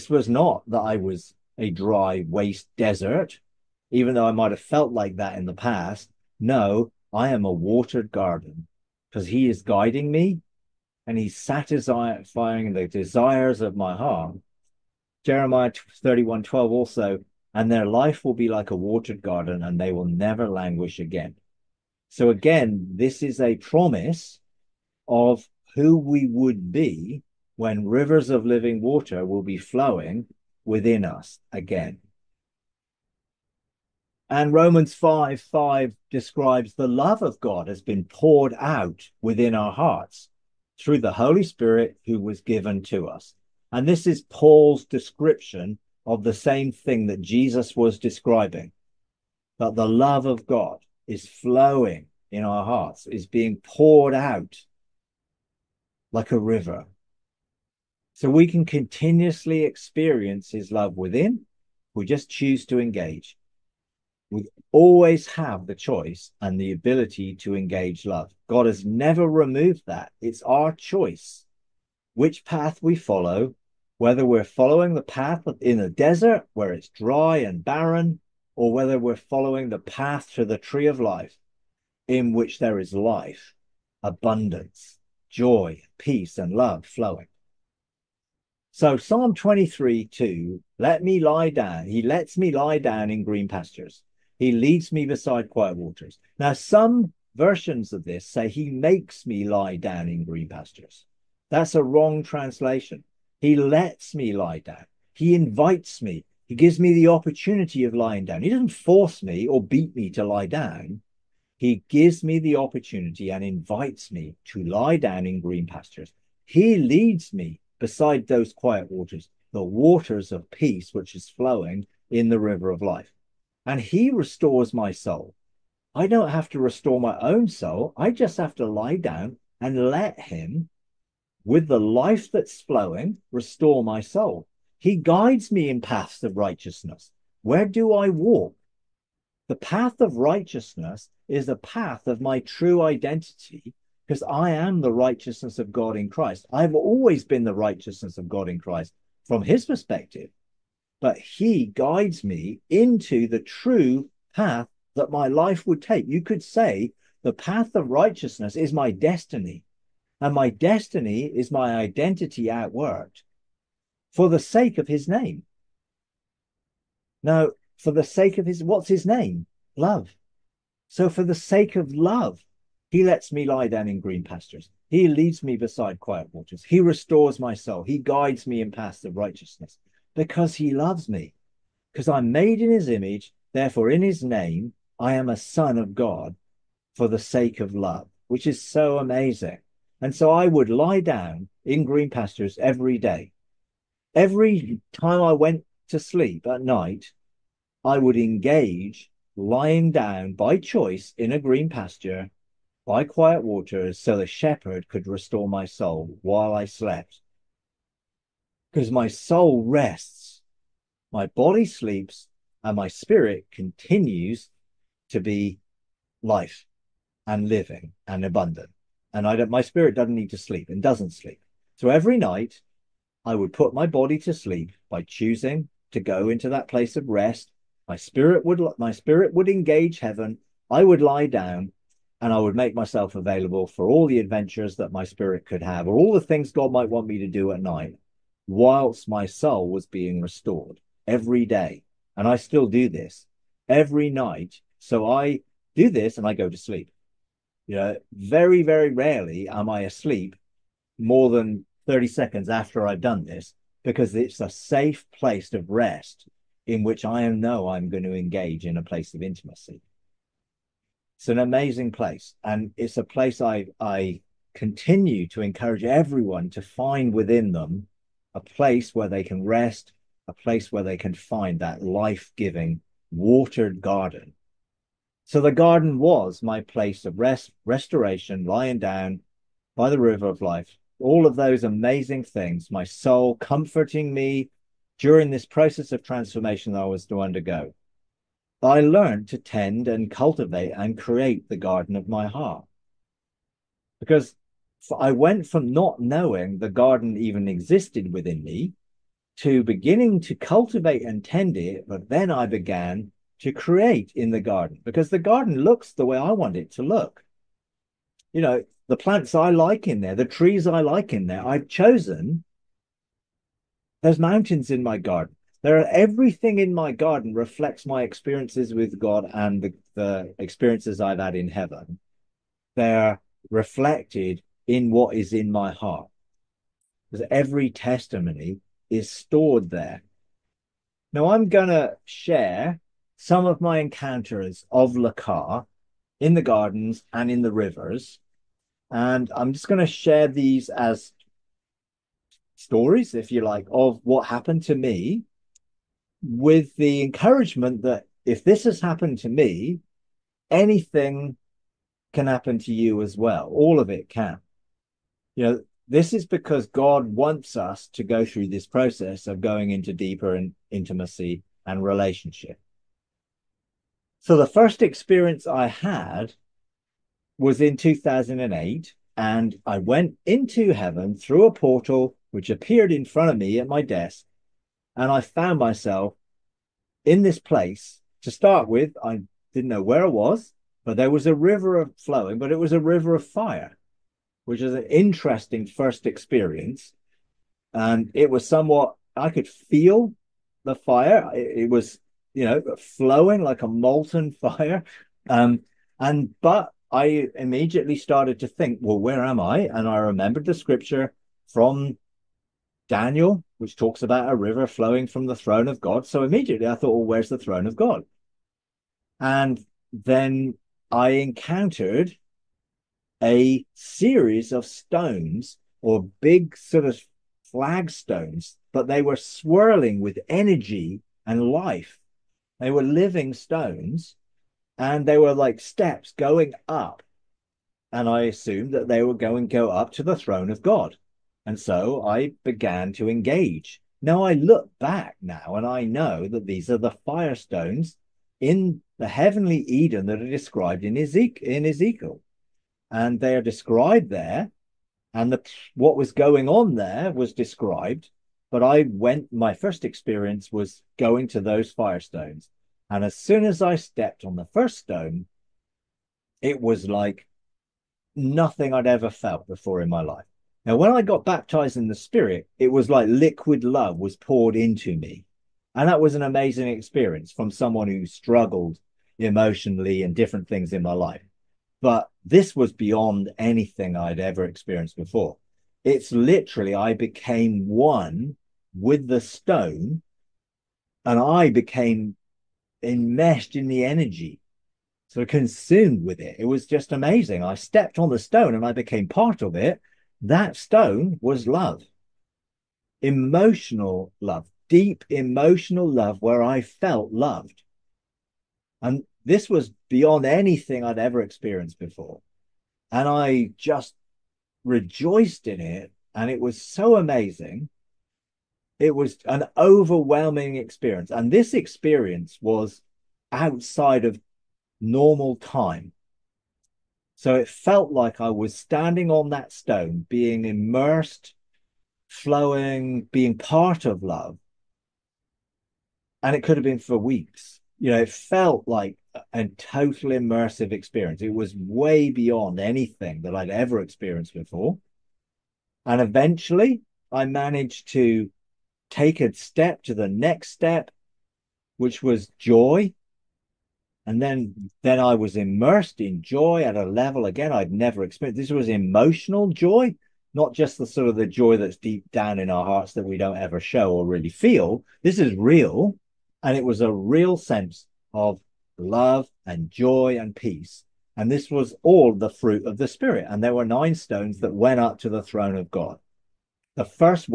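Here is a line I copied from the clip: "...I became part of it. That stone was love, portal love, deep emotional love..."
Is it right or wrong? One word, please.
wrong.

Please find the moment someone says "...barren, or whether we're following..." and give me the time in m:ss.
1:17.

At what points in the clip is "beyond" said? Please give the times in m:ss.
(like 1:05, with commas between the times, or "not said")
7:52, 8:19, 8:52.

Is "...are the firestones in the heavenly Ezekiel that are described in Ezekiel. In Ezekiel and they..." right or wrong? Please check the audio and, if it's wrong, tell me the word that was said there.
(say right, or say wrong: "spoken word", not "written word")
wrong: "Eden", not "Ezekiel".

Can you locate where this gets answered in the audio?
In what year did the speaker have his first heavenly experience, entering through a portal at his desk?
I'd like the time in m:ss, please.
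6:07.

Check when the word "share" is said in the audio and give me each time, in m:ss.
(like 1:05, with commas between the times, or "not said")
5:32, 5:39.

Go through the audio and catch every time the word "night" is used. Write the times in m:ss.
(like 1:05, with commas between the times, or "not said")
3:16, 3:42, 3:57, 4:04.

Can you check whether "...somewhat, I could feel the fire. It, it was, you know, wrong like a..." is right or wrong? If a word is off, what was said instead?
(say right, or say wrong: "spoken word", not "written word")
wrong: "flowing", not "wrong".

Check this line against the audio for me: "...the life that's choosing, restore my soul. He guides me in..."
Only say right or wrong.
wrong.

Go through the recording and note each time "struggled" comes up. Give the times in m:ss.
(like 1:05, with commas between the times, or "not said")
7:48.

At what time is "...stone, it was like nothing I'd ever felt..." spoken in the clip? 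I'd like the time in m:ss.
7:34.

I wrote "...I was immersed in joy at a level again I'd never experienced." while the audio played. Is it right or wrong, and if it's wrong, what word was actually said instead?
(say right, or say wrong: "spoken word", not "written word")
right.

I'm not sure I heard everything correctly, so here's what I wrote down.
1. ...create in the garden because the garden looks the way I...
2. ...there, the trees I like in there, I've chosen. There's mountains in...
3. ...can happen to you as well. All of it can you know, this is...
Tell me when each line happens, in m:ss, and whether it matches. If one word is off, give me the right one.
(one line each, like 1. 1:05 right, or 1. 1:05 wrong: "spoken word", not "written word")
1. 5:03 right
2. 5:10 right
3. 5:52 right.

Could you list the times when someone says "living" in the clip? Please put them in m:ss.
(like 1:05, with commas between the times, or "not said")
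0:28, 3:37, 7:02.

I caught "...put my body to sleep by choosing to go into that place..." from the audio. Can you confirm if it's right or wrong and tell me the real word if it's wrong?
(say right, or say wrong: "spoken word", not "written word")
right.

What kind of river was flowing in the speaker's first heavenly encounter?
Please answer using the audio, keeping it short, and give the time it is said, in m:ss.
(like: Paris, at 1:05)
A river of fire, at 6:22.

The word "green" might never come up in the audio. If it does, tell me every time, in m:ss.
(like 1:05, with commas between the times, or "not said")
1:33, 1:40, 1:55, 2:54, 3:11, 3:21.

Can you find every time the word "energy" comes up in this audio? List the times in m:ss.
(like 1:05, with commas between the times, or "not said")
7:00, 8:03.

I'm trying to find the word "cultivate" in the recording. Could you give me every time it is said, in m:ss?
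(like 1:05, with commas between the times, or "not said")
4:50, 5:00.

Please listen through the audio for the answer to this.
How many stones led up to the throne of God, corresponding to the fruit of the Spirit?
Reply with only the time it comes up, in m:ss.
9:23.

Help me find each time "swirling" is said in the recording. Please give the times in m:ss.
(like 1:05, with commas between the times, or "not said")
6:59.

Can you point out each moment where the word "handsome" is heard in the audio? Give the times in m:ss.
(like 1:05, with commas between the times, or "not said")
not said.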